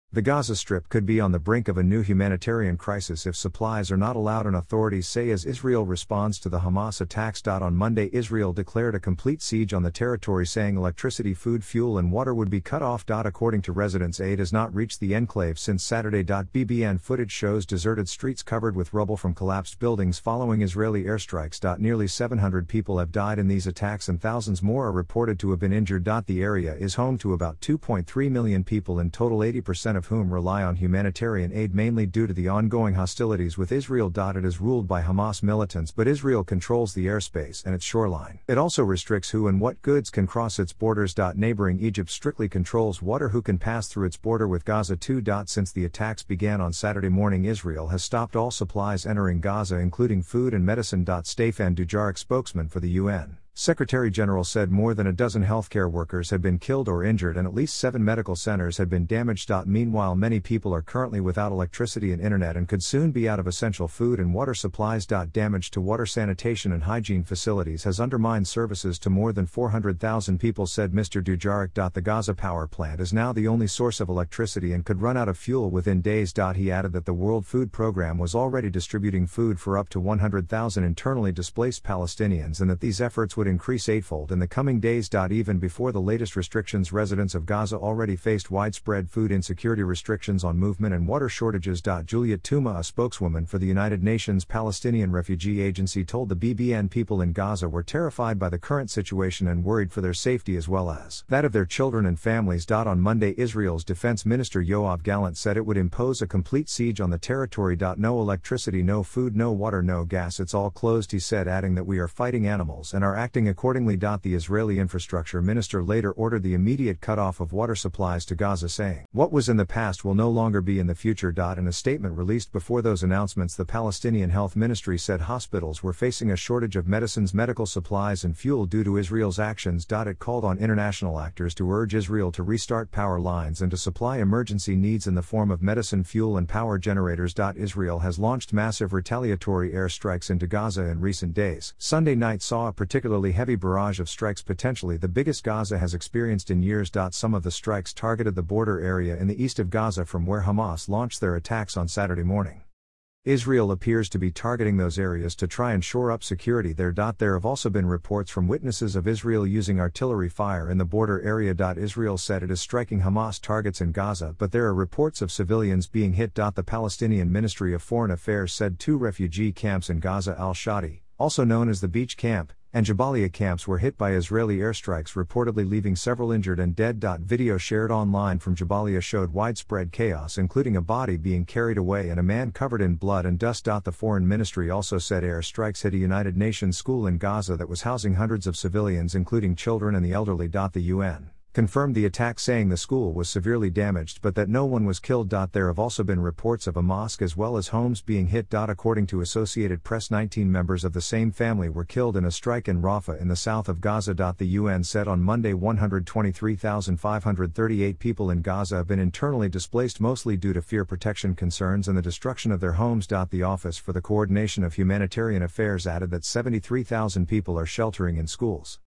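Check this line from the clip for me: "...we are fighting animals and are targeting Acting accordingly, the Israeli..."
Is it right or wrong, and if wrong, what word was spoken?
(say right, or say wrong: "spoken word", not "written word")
wrong: "acting", not "targeting".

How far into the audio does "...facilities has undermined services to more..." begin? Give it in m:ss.
1:07.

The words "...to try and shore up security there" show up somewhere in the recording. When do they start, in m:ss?
2:35.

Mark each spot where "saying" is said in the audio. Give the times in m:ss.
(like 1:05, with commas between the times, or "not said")
0:10, 1:58, 3:12.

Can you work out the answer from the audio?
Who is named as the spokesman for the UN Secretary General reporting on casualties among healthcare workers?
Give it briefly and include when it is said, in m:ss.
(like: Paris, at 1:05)
Stefan Dujarric, at 0:51.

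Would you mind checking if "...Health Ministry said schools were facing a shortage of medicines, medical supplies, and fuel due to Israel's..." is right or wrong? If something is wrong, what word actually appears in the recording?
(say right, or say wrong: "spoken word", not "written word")
wrong: "hospitals", not "schools".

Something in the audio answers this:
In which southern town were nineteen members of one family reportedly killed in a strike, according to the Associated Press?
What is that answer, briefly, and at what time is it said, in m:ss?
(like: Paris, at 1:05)
Rafah, at 3:22.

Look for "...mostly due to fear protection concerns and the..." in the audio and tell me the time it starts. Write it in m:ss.
3:30.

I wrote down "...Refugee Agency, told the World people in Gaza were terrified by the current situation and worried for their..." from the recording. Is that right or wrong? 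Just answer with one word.
wrong.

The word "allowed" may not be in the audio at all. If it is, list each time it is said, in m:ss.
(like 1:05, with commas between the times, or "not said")
0:04.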